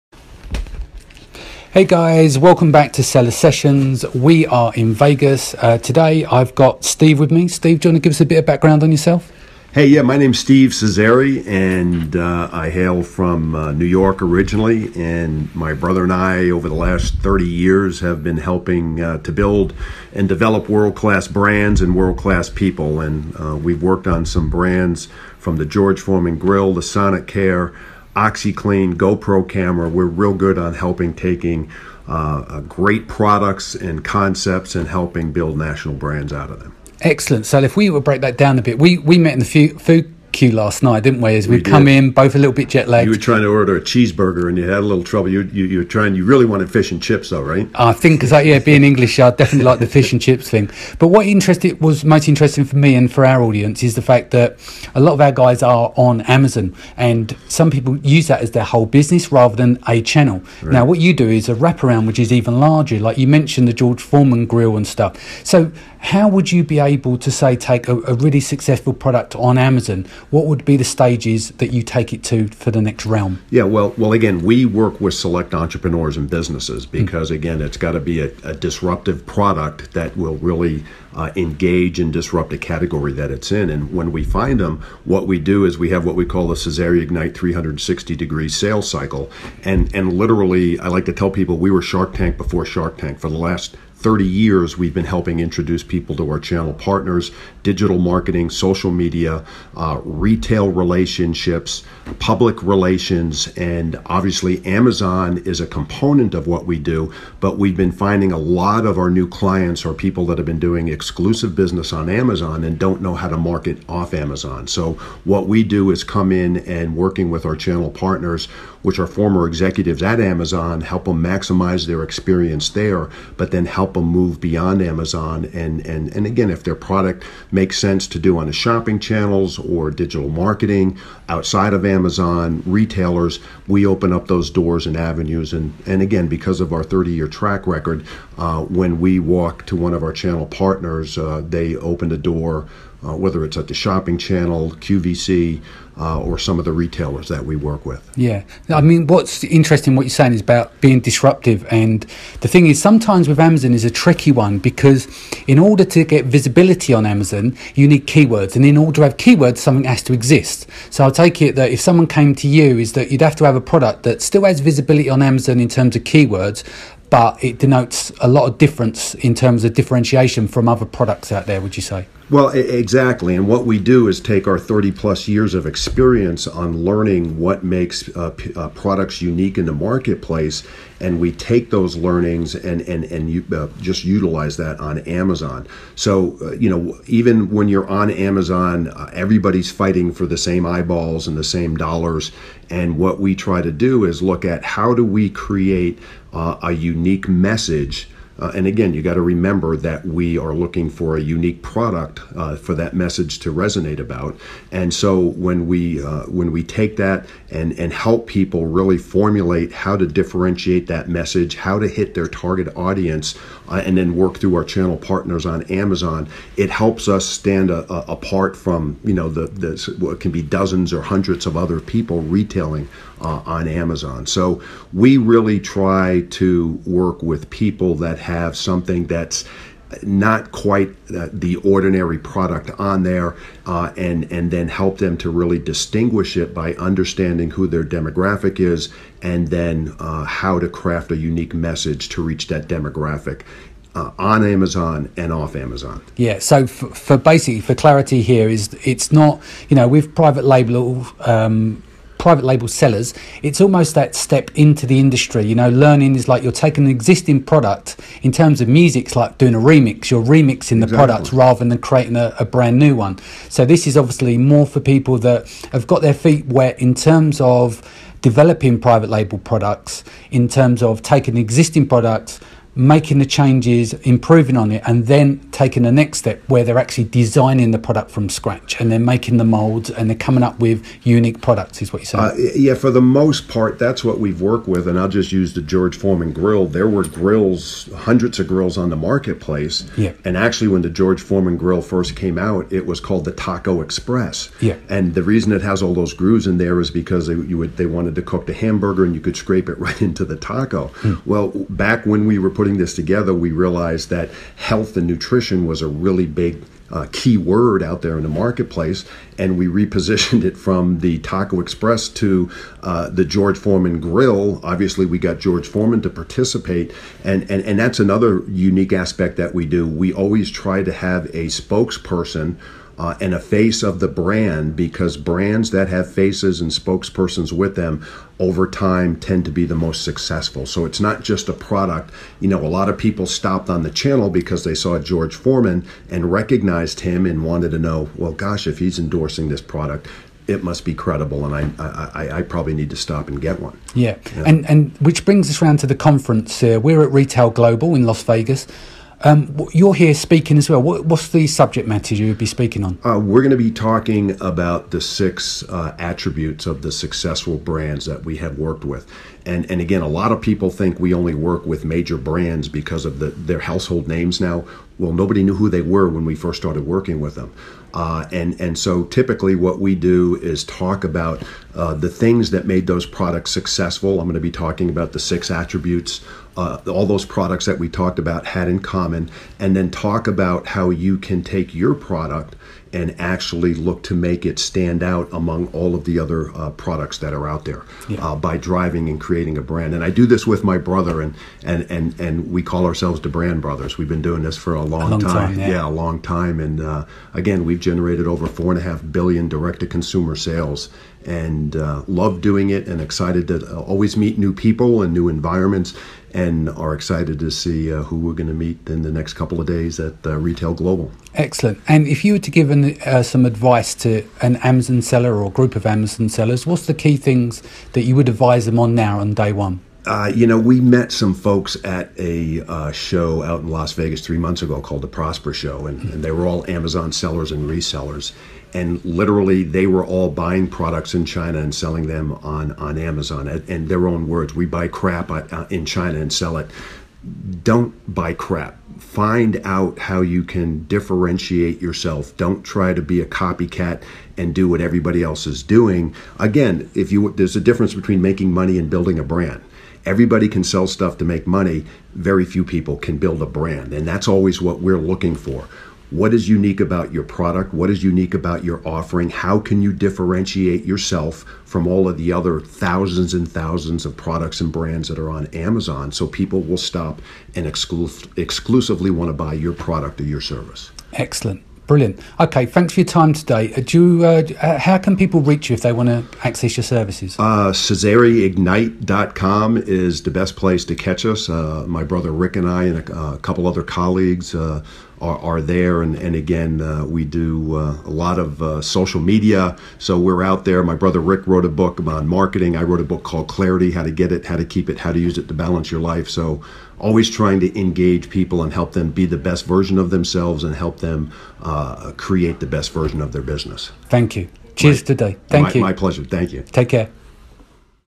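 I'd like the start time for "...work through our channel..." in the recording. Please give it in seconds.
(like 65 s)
214 s.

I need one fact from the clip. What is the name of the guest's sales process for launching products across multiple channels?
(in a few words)
Cesari Ignite 360 degree sales cycle.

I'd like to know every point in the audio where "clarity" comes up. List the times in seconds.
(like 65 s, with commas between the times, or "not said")
247 s, 493 s.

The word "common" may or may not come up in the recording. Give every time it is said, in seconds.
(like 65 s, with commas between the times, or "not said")
378 s.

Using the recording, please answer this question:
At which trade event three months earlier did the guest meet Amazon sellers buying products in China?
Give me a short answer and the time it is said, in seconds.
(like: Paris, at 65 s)
Prosper Show, at 425 s.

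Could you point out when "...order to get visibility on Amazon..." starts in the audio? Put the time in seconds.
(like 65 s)
155 s.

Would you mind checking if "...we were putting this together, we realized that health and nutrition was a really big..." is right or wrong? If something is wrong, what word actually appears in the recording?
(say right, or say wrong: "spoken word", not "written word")
right.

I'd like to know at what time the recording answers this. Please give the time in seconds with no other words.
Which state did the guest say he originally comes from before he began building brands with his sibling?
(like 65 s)
13 s.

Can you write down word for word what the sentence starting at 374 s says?
I'm going to be talking about the six attributes.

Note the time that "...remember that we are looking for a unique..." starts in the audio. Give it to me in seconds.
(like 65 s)
199 s.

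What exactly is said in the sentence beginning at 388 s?
Uh, by driving increased creating a brand.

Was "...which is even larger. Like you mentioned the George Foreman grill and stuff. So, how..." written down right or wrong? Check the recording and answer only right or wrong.
right.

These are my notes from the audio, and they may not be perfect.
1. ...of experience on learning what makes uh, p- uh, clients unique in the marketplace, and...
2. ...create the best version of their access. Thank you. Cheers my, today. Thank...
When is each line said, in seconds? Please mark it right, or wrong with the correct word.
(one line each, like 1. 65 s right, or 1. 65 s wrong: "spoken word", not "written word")
1. 175 s wrong: "products", not "clients"
2. 502 s wrong: "business", not "access".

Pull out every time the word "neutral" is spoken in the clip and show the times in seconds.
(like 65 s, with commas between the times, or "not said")
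not said.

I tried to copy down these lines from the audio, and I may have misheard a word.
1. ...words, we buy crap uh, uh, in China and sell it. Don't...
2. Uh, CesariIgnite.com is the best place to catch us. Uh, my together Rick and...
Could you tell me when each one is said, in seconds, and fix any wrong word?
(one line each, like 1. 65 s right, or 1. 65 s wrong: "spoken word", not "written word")
1. 434 s right
2. 477 s wrong: "brother", not "together".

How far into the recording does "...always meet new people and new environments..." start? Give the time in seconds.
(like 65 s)
403 s.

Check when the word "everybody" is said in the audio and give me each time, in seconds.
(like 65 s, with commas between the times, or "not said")
189 s, 444 s, 450 s.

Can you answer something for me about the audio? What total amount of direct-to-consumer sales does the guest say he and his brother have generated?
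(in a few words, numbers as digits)
4.5 billion.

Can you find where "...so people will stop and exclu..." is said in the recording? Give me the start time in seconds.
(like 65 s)
466 s.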